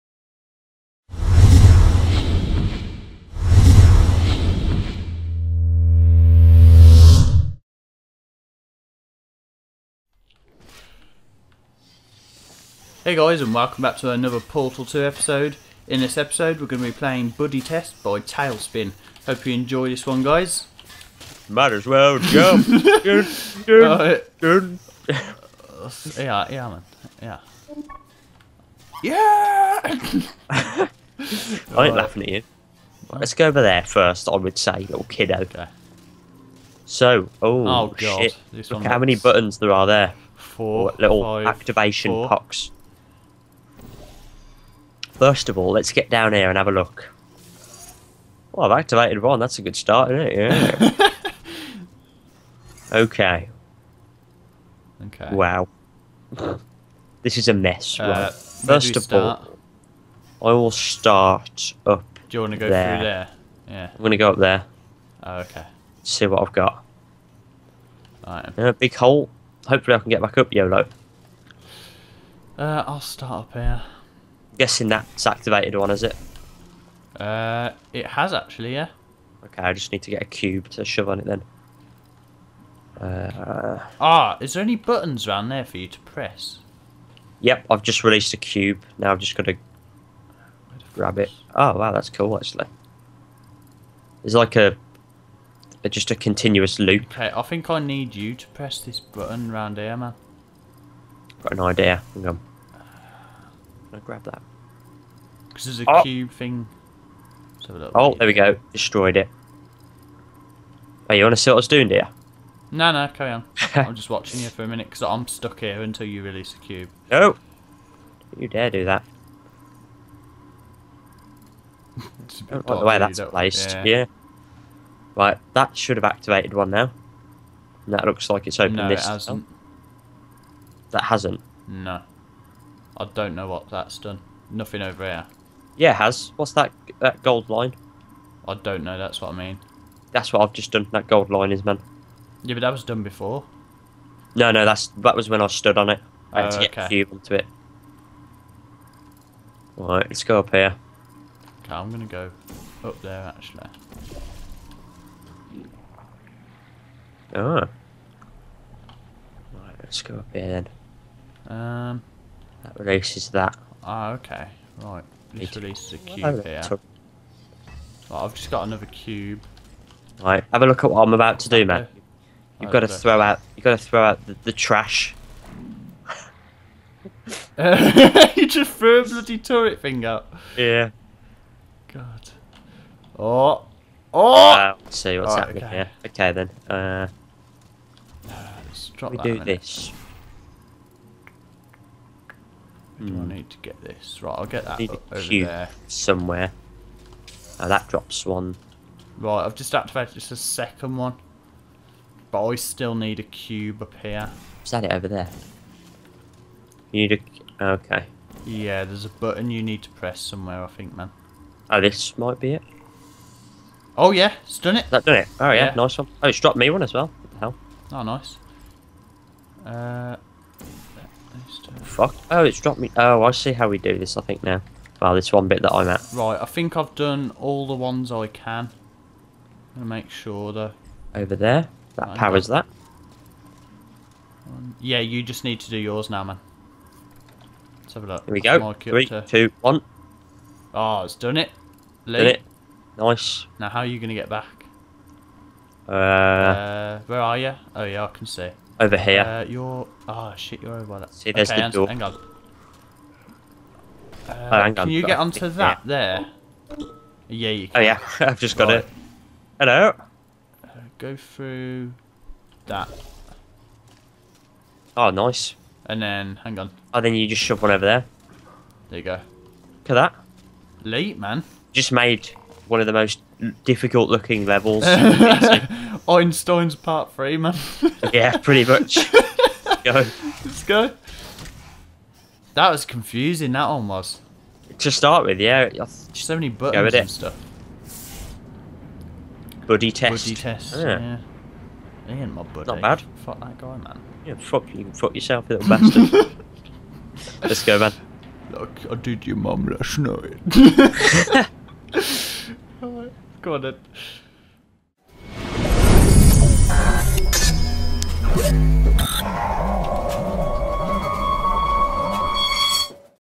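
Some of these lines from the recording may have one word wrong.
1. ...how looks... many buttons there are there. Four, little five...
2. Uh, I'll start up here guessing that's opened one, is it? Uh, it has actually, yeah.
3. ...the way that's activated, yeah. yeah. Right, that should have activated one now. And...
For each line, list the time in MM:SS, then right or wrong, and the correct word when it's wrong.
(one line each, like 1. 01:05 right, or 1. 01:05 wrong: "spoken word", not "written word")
1. 00:38 right
2. 01:12 wrong: "activated", not "opened"
3. 02:02 wrong: "placed", not "activated".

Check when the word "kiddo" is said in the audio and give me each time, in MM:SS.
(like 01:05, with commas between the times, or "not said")
00:35.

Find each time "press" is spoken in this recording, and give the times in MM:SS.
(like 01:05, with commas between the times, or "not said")
01:26, 01:38, 03:29.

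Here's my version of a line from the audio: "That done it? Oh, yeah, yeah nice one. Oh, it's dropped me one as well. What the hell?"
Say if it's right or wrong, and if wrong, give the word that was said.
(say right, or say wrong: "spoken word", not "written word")
right.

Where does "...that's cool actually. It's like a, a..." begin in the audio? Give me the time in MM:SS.
01:31.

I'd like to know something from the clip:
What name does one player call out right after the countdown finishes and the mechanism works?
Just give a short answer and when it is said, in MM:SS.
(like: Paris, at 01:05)
Lee, at 04:02.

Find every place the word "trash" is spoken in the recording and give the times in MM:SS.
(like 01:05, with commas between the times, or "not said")
02:54.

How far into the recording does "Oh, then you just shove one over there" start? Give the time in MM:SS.
04:26.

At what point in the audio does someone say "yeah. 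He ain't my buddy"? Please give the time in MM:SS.
04:50.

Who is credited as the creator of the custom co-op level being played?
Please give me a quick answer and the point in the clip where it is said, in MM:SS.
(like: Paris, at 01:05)
Tailspin, at 00:18.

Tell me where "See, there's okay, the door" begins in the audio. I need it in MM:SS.
04:11.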